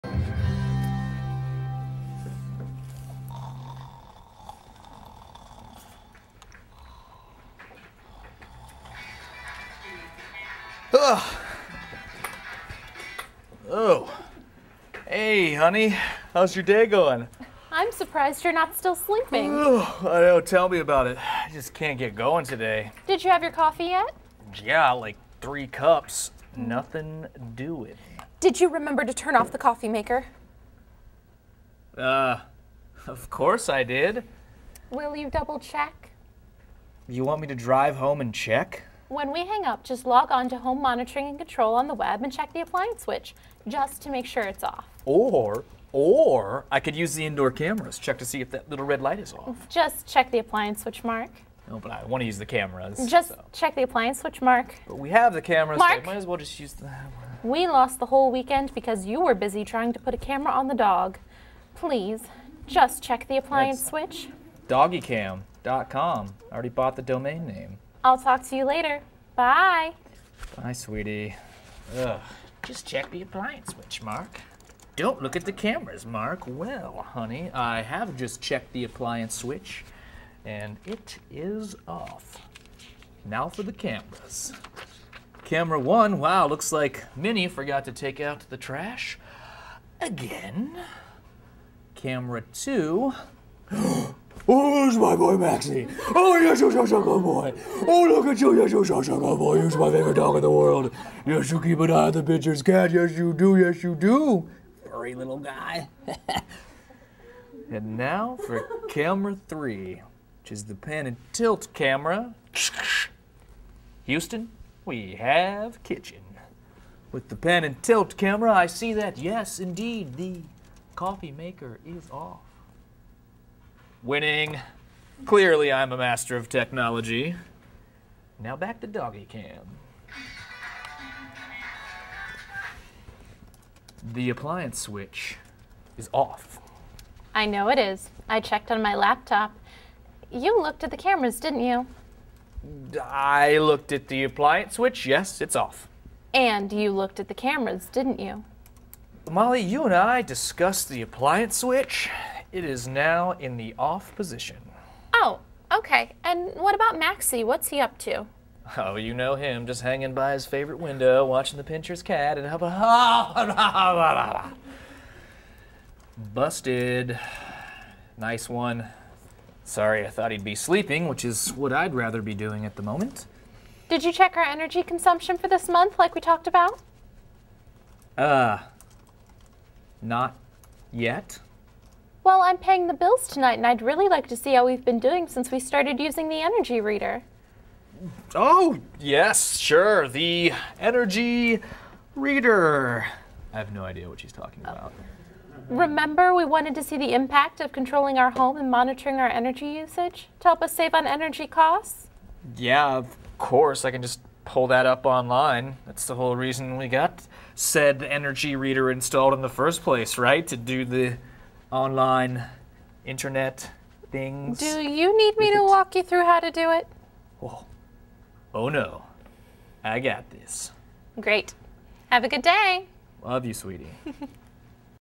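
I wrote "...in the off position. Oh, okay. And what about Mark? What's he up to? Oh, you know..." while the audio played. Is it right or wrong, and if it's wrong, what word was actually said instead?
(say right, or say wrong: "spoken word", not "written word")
wrong: "Maxie", not "Mark".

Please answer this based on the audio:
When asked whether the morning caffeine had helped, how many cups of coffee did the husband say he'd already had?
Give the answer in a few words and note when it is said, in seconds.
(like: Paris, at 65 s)
3, at 25 s.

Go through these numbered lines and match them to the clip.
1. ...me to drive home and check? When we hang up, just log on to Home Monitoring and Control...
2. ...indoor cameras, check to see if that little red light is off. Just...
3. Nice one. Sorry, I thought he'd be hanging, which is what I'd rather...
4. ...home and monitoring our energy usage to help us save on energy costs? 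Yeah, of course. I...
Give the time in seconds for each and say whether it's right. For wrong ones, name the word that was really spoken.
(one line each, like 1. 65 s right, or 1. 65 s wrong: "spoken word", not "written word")
1. 37 s right
2. 47 s right
3. 168 s wrong: "sleeping", not "hanging"
4. 198 s right.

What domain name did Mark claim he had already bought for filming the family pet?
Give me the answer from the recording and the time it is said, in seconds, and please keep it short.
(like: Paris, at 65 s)
Doggycam.com, at 64 s.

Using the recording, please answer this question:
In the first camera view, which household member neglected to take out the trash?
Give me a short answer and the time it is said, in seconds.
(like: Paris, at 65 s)
Minnie, at 87 s.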